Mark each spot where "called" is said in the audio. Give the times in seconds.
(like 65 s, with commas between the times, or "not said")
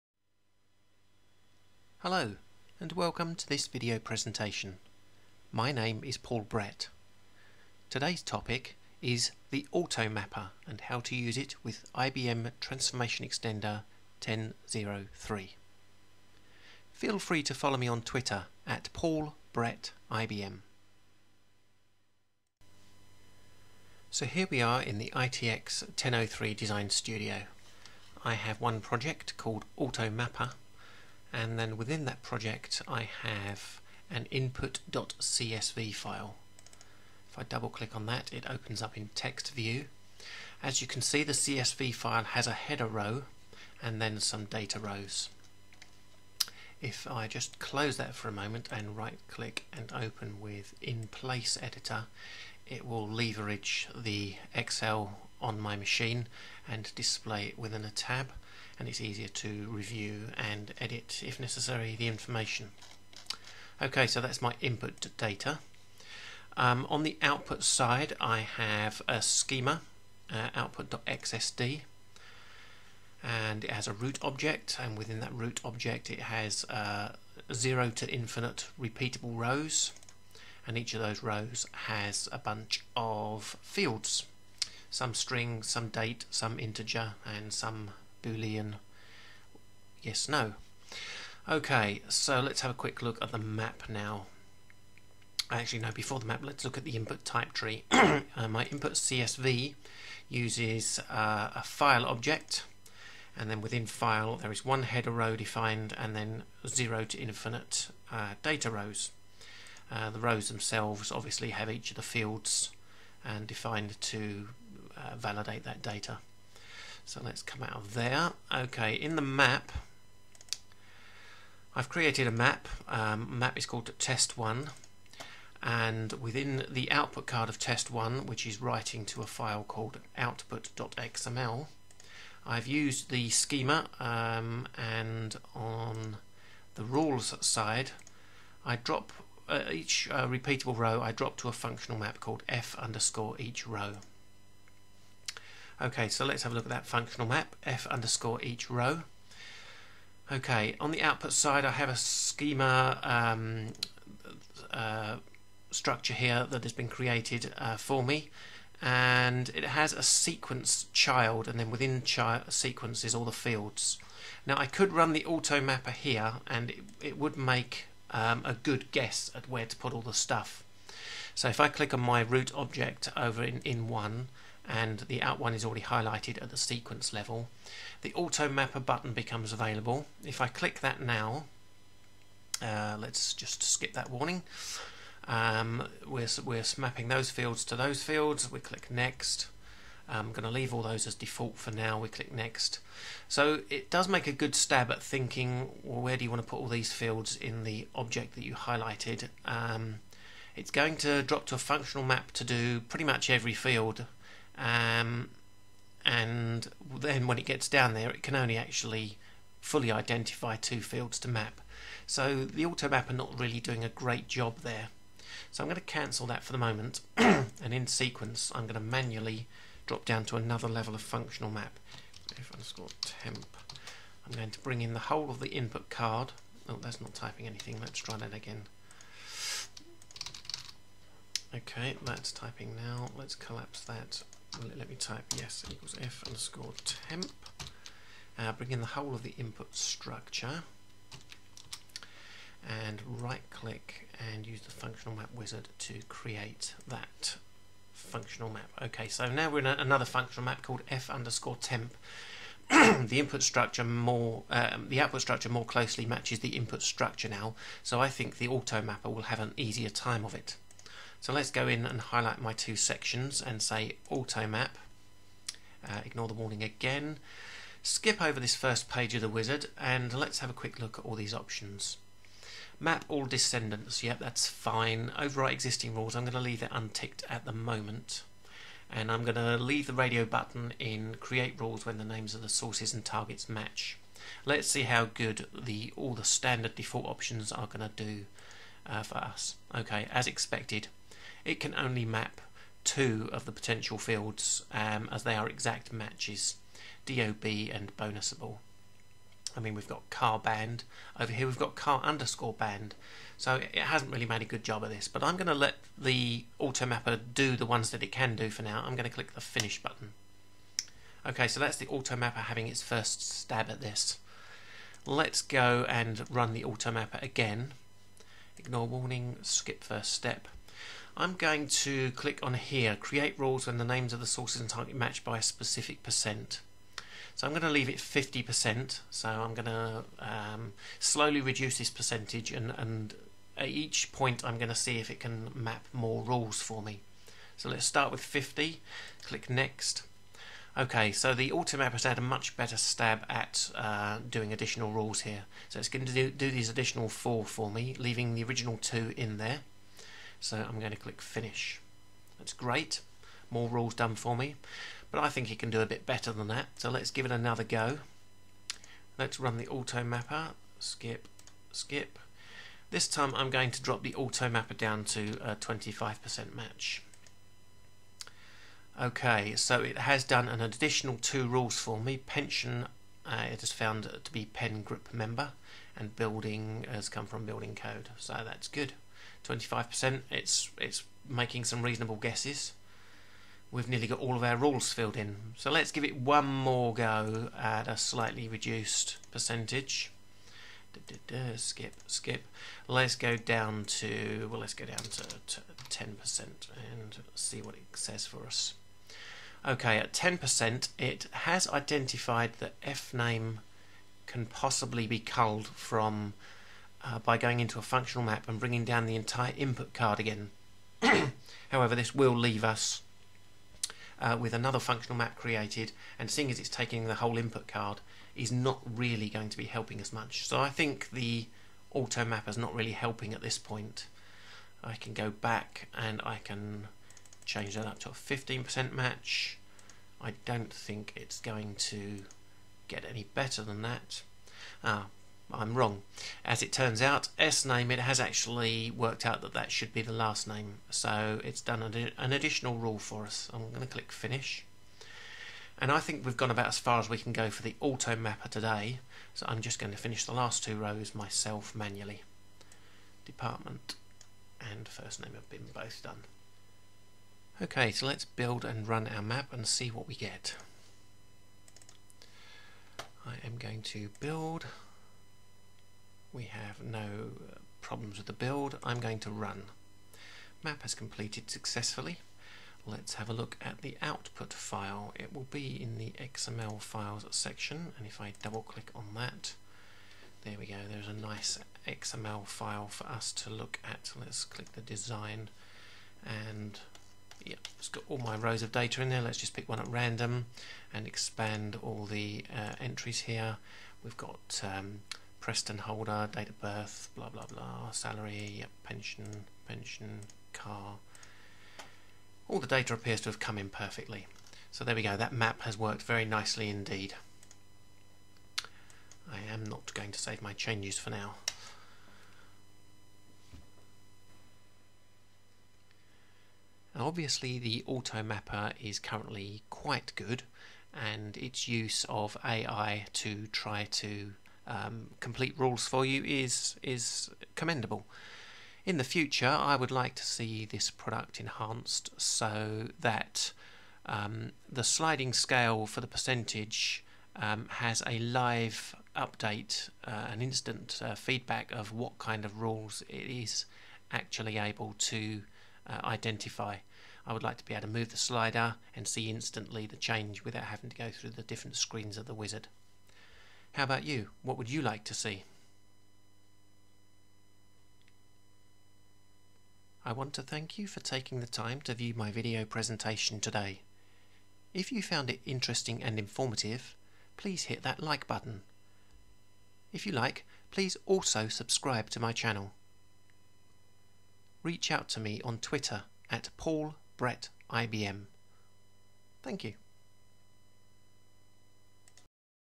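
29 s, 123 s, 129 s, 142 s, 250 s.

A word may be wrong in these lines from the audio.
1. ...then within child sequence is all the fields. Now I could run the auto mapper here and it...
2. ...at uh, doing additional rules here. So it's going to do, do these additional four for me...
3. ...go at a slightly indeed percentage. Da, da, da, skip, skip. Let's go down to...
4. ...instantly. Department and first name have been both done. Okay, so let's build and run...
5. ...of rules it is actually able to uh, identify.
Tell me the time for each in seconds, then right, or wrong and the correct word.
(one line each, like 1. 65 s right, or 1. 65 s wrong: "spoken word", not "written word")
1. 161 s right
2. 343 s right
3. 386 s wrong: "reduced", not "indeed"
4. 451 s wrong: "manually", not "instantly"
5. 542 s right.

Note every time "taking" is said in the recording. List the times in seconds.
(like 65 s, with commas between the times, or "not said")
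416 s, 560 s.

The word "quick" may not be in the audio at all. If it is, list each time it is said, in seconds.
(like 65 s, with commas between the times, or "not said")
92 s, 270 s.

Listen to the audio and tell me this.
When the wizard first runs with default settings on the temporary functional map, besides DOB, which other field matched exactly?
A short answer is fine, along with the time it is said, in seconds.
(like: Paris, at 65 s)
bonusable, at 297 s.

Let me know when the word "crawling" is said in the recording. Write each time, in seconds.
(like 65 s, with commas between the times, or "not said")
not said.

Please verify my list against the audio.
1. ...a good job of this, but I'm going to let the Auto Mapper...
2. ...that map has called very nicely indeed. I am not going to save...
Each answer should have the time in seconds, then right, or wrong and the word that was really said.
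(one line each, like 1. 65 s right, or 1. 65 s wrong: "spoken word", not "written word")
1. 304 s right
2. 505 s wrong: "worked", not "called".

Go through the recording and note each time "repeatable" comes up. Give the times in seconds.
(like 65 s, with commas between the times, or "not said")
78 s, 140 s.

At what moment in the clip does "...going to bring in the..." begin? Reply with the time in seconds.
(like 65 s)
224 s.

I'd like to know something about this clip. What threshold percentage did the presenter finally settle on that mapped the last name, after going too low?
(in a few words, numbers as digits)
15%.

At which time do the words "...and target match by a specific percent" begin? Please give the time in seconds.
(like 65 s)
324 s.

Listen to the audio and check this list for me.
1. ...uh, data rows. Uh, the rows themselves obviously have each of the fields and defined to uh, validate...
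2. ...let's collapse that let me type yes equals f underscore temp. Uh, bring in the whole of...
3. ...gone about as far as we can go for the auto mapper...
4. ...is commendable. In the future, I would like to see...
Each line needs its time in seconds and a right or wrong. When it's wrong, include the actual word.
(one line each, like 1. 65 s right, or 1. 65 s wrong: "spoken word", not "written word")
1. 108 s right
2. 233 s right
3. 446 s right
4. 526 s right.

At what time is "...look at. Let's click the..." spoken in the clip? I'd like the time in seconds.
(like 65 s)
483 s.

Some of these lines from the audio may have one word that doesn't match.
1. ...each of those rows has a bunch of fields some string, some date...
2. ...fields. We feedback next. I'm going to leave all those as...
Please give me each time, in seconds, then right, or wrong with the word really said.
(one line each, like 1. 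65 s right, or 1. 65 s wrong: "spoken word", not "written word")
1. 80 s right
2. 188 s wrong: "click", not "feedback".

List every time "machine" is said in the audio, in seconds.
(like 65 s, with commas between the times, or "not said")
55 s.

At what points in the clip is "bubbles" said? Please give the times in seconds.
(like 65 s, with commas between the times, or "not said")
not said.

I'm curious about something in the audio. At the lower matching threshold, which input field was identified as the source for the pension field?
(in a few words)
pen group member.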